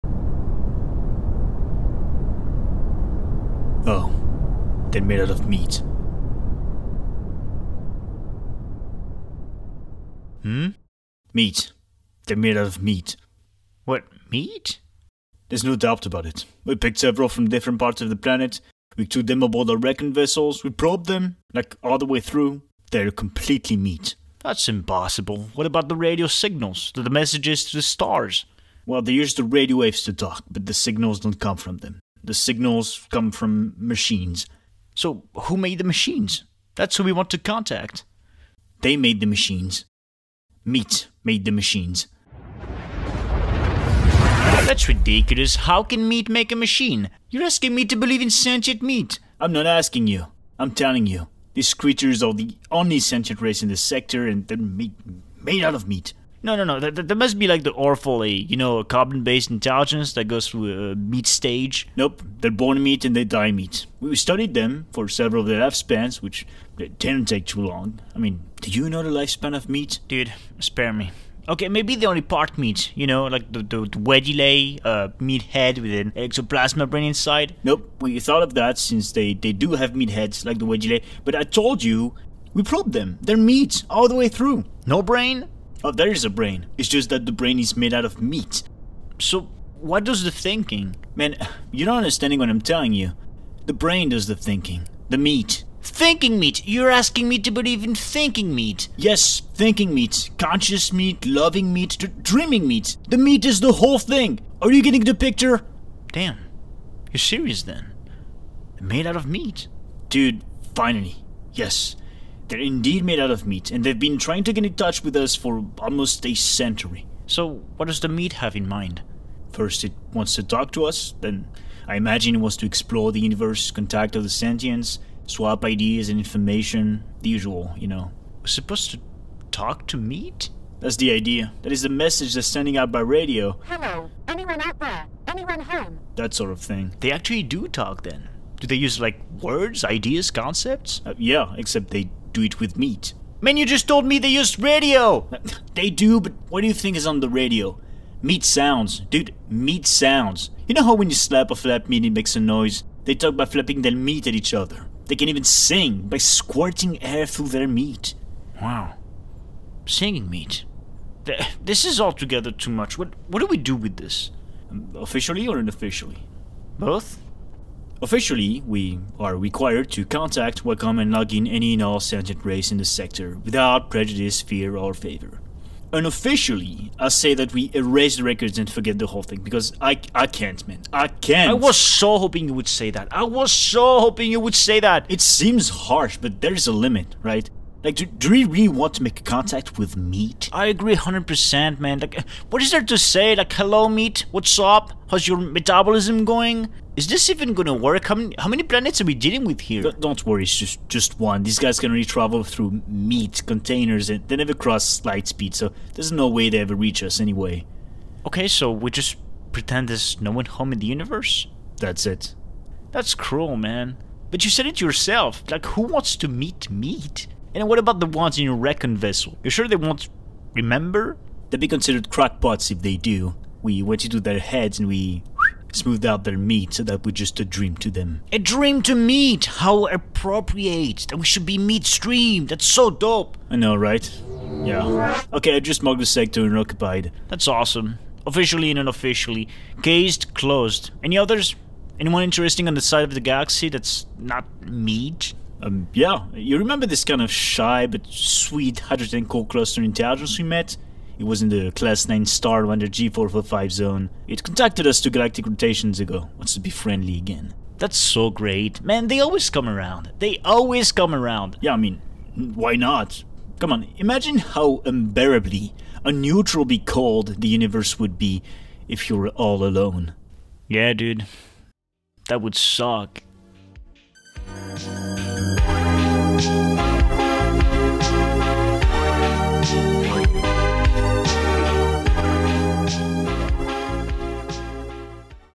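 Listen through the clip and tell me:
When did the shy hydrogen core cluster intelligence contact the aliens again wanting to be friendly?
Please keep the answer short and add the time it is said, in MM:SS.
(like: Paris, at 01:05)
2 galactic rotations ago, at 04:15.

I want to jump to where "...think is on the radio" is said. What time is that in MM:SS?
02:26.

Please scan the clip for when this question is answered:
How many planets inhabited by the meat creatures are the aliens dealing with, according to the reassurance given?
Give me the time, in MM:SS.
03:20.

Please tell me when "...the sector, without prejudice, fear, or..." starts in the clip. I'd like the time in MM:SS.
02:52.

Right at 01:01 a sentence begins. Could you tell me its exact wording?
Nope, they're born meat and they die meat.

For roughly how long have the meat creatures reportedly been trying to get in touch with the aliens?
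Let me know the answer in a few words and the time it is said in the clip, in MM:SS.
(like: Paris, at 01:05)
almost a century, at 01:55.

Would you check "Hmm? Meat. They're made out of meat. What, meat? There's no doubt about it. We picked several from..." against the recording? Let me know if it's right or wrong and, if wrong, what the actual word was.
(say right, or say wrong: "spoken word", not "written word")
right.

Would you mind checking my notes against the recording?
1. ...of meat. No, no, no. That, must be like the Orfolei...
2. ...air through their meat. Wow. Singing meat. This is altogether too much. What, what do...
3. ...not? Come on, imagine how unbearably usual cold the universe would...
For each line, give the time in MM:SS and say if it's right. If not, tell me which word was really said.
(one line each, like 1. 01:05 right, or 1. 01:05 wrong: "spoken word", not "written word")
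1. 00:55 right
2. 02:37 right
3. 04:22 wrong: "unneutral", not "usual".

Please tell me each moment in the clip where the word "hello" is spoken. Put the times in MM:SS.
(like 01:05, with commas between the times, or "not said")
02:13, 03:13.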